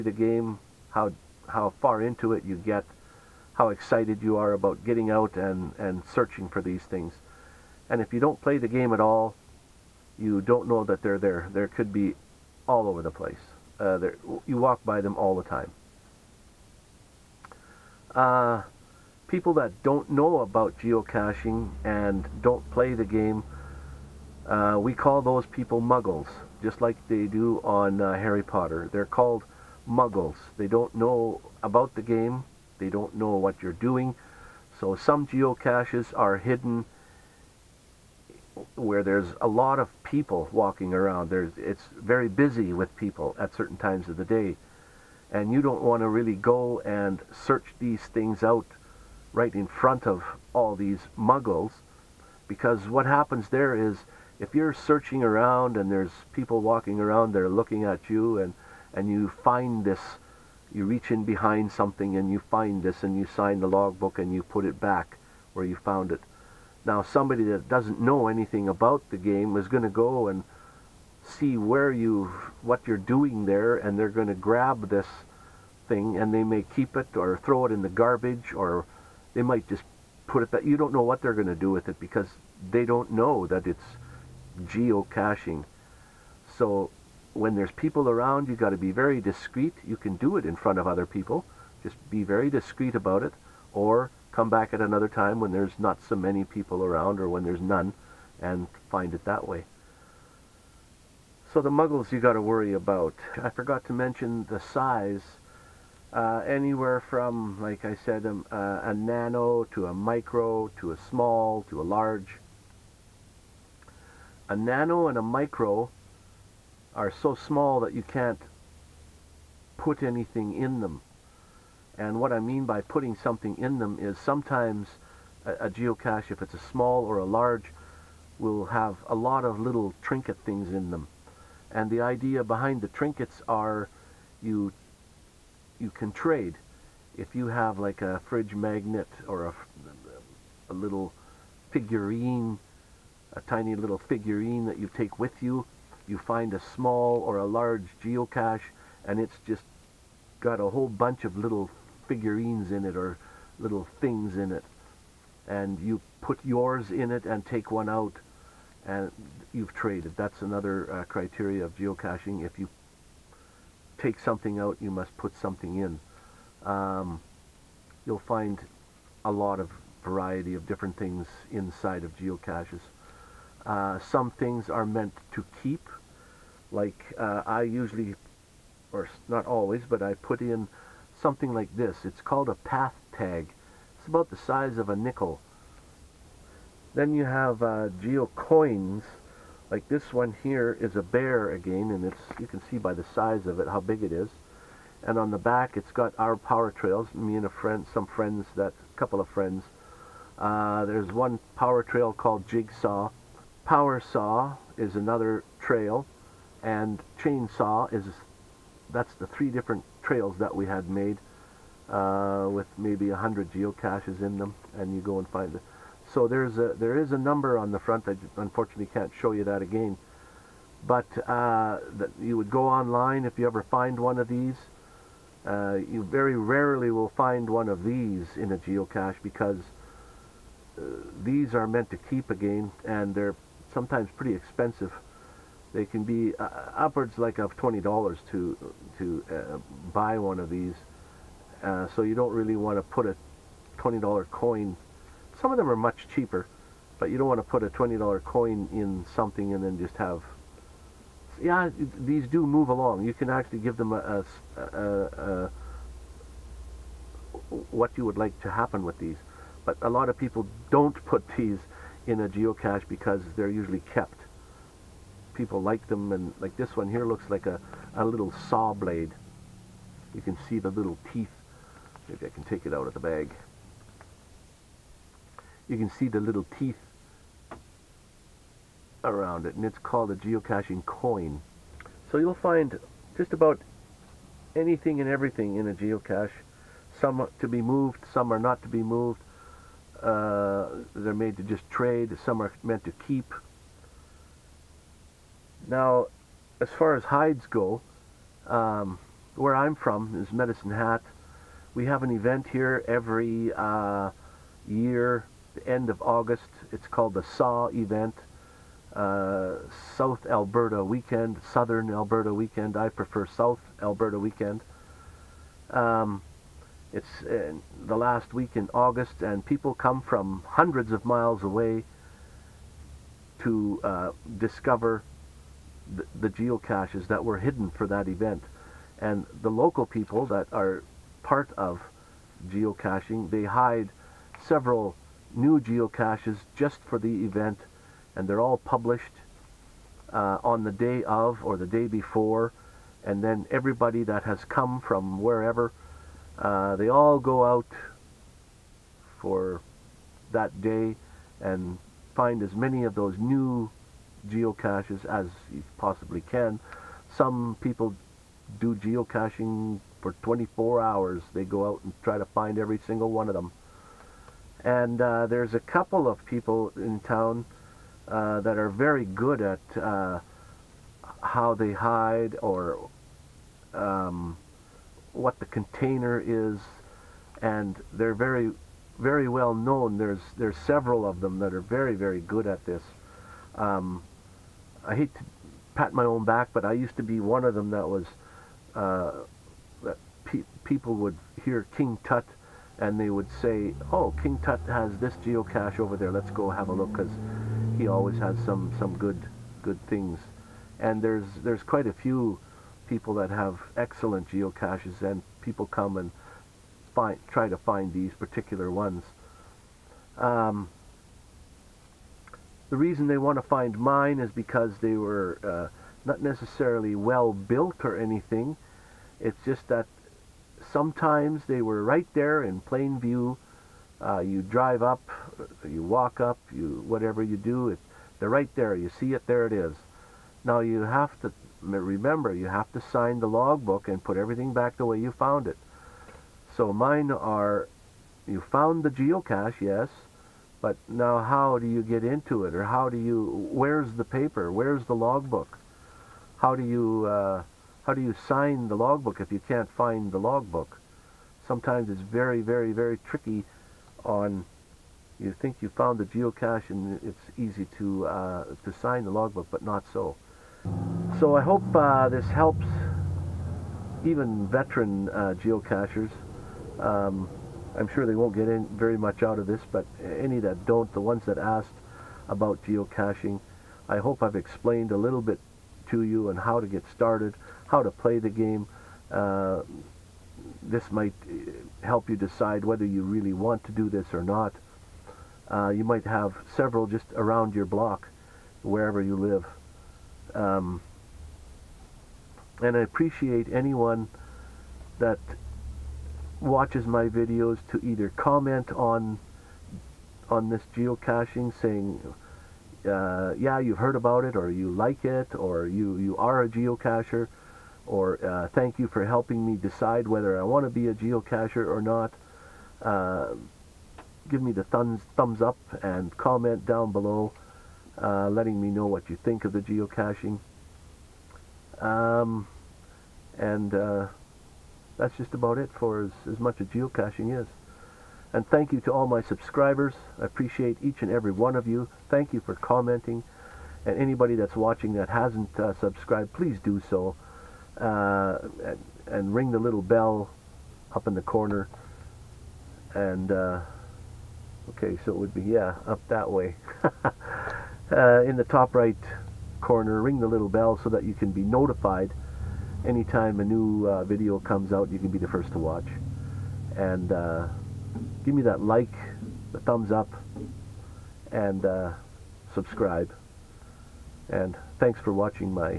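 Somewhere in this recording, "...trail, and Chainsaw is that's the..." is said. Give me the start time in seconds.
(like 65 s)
205 s.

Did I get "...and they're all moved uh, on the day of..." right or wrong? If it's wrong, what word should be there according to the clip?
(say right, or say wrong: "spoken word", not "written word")
wrong: "published", not "moved".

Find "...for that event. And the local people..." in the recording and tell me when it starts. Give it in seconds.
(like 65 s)
327 s.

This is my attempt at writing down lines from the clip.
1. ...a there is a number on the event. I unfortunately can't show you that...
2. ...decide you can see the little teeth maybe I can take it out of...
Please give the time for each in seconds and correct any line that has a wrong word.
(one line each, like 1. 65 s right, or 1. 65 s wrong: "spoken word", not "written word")
1. 216 s wrong: "front", not "event"
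2. 268 s wrong: "blade", not "decide".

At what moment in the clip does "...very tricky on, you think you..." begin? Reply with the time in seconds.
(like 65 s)
452 s.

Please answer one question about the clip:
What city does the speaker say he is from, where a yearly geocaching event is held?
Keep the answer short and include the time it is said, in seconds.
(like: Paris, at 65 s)
Medicine Hat, at 300 s.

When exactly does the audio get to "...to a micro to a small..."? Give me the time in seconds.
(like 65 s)
109 s.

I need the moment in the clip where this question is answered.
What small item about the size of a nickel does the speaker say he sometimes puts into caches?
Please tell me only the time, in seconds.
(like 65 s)
182 s.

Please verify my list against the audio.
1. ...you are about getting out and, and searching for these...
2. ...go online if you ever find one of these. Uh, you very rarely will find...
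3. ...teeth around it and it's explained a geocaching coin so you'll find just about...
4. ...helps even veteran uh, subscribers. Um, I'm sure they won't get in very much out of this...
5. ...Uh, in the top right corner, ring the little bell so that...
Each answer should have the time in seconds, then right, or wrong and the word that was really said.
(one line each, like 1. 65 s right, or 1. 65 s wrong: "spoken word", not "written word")
1. 4 s right
2. 222 s right
3. 276 s wrong: "called", not "explained"
4. 462 s wrong: "geocachers", not "subscribers"
5. 547 s right.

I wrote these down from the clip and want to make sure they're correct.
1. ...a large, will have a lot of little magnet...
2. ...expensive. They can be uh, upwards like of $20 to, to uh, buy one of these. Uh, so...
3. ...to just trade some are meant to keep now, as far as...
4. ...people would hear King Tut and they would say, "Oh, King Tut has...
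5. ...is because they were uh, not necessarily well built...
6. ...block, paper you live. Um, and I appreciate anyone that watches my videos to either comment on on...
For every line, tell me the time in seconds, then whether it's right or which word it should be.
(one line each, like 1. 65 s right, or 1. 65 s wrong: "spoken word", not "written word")
1. 127 s wrong: "trinket", not "magnet"
2. 234 s right
3. 291 s right
4. 390 s right
5. 414 s right
6. 487 s wrong: "wherever", not "paper".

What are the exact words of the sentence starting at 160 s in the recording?
That's another uh, criteria of geocaching.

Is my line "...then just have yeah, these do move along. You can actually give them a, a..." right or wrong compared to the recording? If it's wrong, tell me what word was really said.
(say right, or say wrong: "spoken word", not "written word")
right.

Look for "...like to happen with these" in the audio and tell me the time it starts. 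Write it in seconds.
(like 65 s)
258 s.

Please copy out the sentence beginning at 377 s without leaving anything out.
And they're very, very well known.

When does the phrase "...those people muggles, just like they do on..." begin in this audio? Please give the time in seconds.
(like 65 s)
25 s.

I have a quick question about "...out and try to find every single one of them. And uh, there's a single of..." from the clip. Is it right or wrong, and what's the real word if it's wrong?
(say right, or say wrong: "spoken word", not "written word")
wrong: "couple", not "single".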